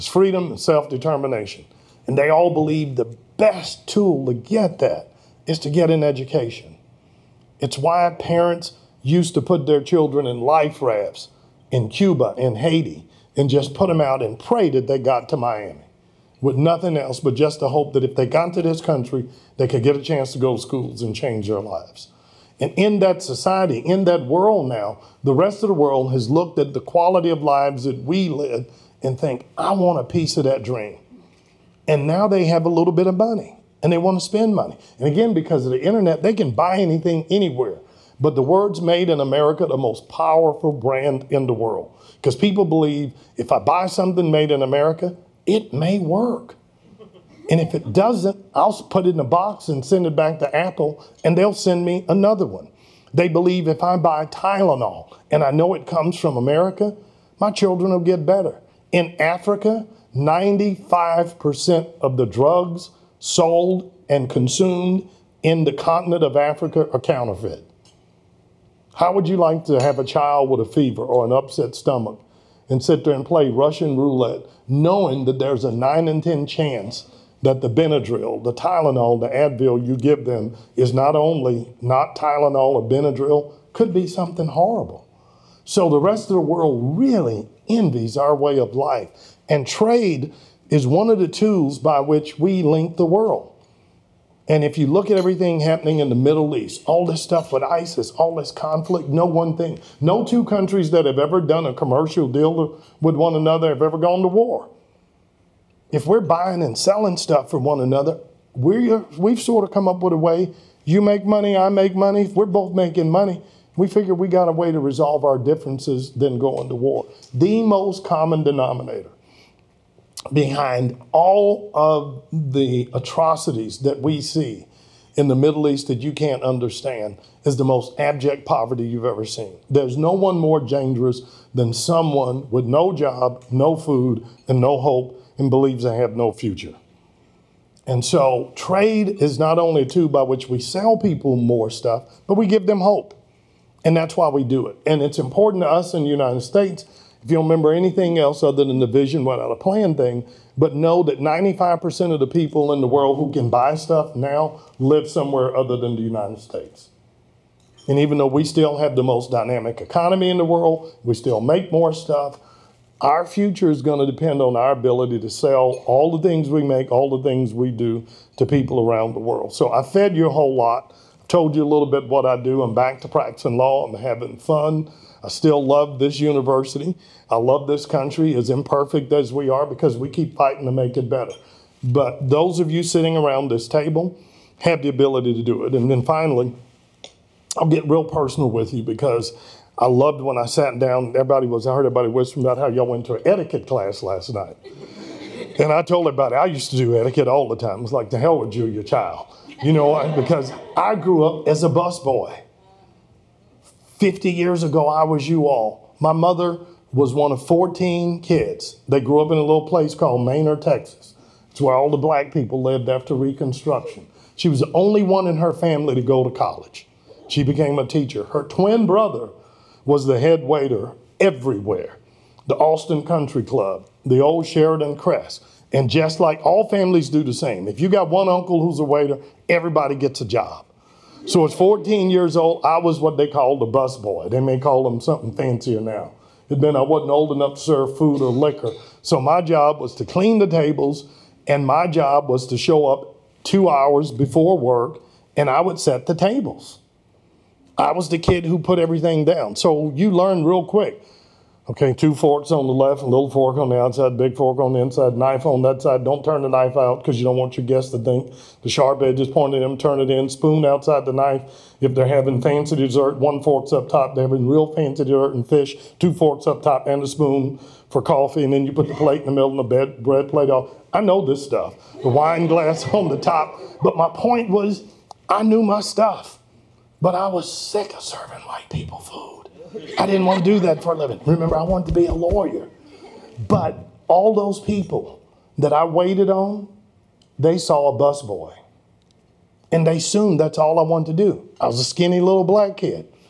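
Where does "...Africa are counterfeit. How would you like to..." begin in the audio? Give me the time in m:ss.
1:06.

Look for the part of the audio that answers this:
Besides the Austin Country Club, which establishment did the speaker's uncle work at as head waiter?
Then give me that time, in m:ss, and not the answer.
3:44.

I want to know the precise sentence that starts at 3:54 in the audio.
They may call them something fancier now.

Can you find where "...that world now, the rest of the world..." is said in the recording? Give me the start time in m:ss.
0:24.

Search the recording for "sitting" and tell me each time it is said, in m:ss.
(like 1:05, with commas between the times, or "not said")
3:02.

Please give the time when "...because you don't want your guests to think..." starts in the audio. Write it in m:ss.
4:17.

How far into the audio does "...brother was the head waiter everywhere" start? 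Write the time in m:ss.
3:38.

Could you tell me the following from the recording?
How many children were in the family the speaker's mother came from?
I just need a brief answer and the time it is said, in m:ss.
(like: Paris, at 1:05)
14, at 3:27.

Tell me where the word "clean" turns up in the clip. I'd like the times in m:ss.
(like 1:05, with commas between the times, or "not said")
4:00.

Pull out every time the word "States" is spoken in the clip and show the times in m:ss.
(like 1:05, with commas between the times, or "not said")
2:26, 2:36.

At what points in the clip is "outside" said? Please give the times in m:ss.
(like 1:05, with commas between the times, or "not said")
4:13, 4:20.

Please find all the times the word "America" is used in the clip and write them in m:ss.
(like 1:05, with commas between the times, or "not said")
0:39, 0:44, 0:56.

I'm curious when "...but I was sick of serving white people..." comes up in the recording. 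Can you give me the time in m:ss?
4:37.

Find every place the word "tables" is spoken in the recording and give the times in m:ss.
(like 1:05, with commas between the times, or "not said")
3:03, 4:00, 4:06.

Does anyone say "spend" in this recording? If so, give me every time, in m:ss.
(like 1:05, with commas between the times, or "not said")
0:34.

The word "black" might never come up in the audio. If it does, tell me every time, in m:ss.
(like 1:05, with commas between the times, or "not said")
3:31, 4:52.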